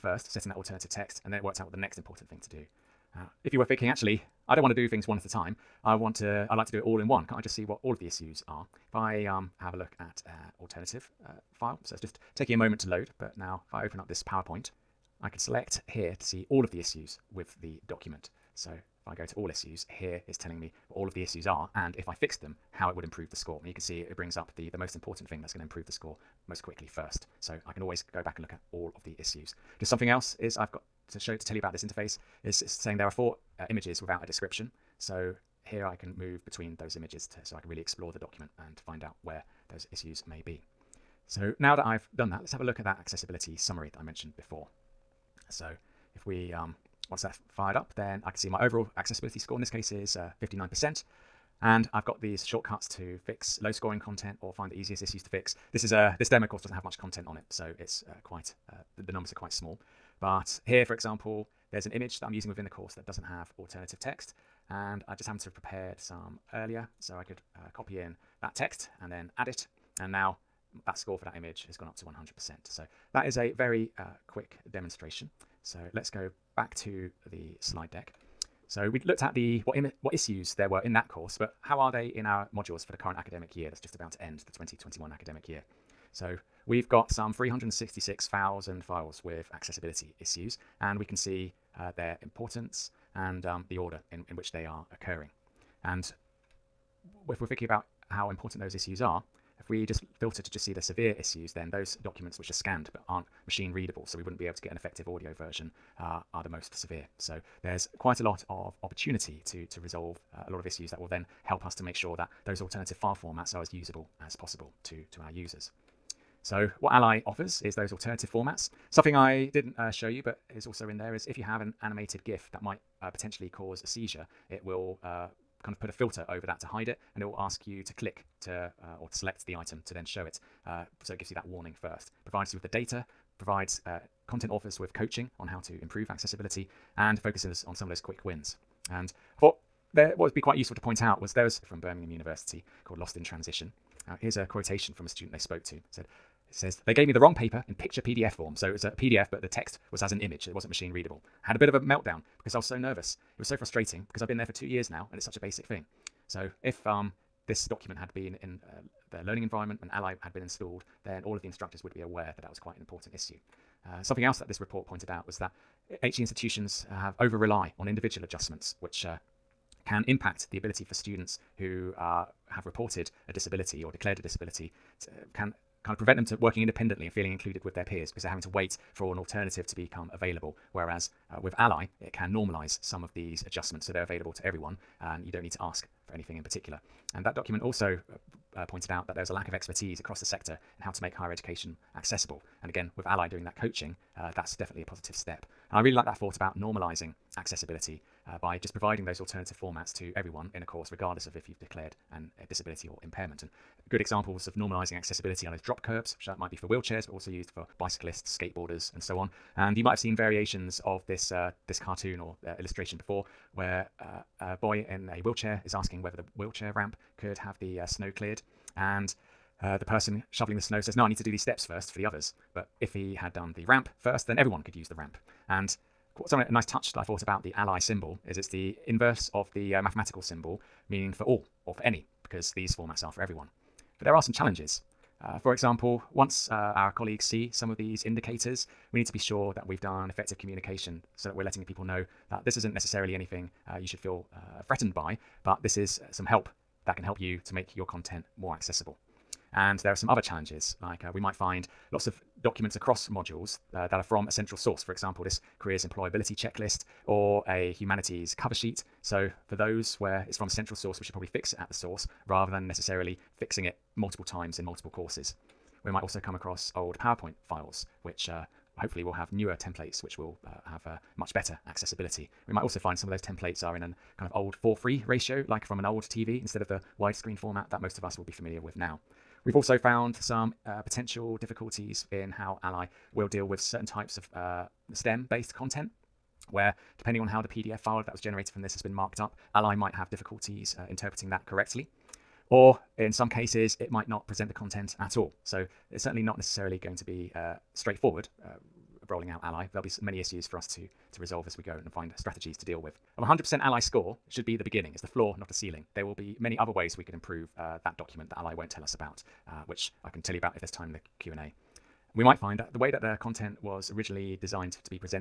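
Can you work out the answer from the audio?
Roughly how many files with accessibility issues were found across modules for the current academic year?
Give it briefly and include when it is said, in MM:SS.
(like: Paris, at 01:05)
366,000, at 01:27.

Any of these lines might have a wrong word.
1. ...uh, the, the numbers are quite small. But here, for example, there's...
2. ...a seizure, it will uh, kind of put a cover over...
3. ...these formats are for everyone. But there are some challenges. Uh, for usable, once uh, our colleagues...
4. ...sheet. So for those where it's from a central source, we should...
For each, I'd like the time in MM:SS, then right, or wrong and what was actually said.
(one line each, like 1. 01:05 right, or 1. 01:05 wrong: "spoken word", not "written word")
1. 00:58 right
2. 02:03 wrong: "filter", not "cover"
3. 03:52 wrong: "example", not "usable"
4. 04:18 right.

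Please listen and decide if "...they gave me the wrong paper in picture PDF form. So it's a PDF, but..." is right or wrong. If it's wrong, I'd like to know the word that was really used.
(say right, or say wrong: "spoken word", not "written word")
right.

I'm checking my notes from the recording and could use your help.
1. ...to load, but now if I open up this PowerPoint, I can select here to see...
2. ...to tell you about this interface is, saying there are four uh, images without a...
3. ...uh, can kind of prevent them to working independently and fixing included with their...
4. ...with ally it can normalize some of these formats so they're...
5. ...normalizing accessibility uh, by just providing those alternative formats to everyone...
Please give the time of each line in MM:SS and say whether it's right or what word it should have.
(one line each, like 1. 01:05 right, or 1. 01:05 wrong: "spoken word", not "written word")
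1. 00:12 right
2. 00:31 right
3. 02:55 wrong: "feeling", not "fixing"
4. 03:01 wrong: "adjustments", not "formats"
5. 03:16 right.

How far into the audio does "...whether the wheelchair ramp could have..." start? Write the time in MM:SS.
03:36.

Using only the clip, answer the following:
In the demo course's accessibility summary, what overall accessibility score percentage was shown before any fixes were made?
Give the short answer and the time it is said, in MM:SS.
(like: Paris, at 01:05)
59%, at 00:50.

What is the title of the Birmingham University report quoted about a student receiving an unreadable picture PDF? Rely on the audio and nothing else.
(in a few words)
Lost in Transition.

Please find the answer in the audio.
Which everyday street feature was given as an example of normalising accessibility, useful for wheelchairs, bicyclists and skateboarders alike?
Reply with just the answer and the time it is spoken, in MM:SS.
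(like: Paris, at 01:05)
drop curbs, at 03:25.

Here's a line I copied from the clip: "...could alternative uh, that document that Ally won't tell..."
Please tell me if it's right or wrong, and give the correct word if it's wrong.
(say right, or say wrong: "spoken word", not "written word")
wrong: "improve", not "alternative".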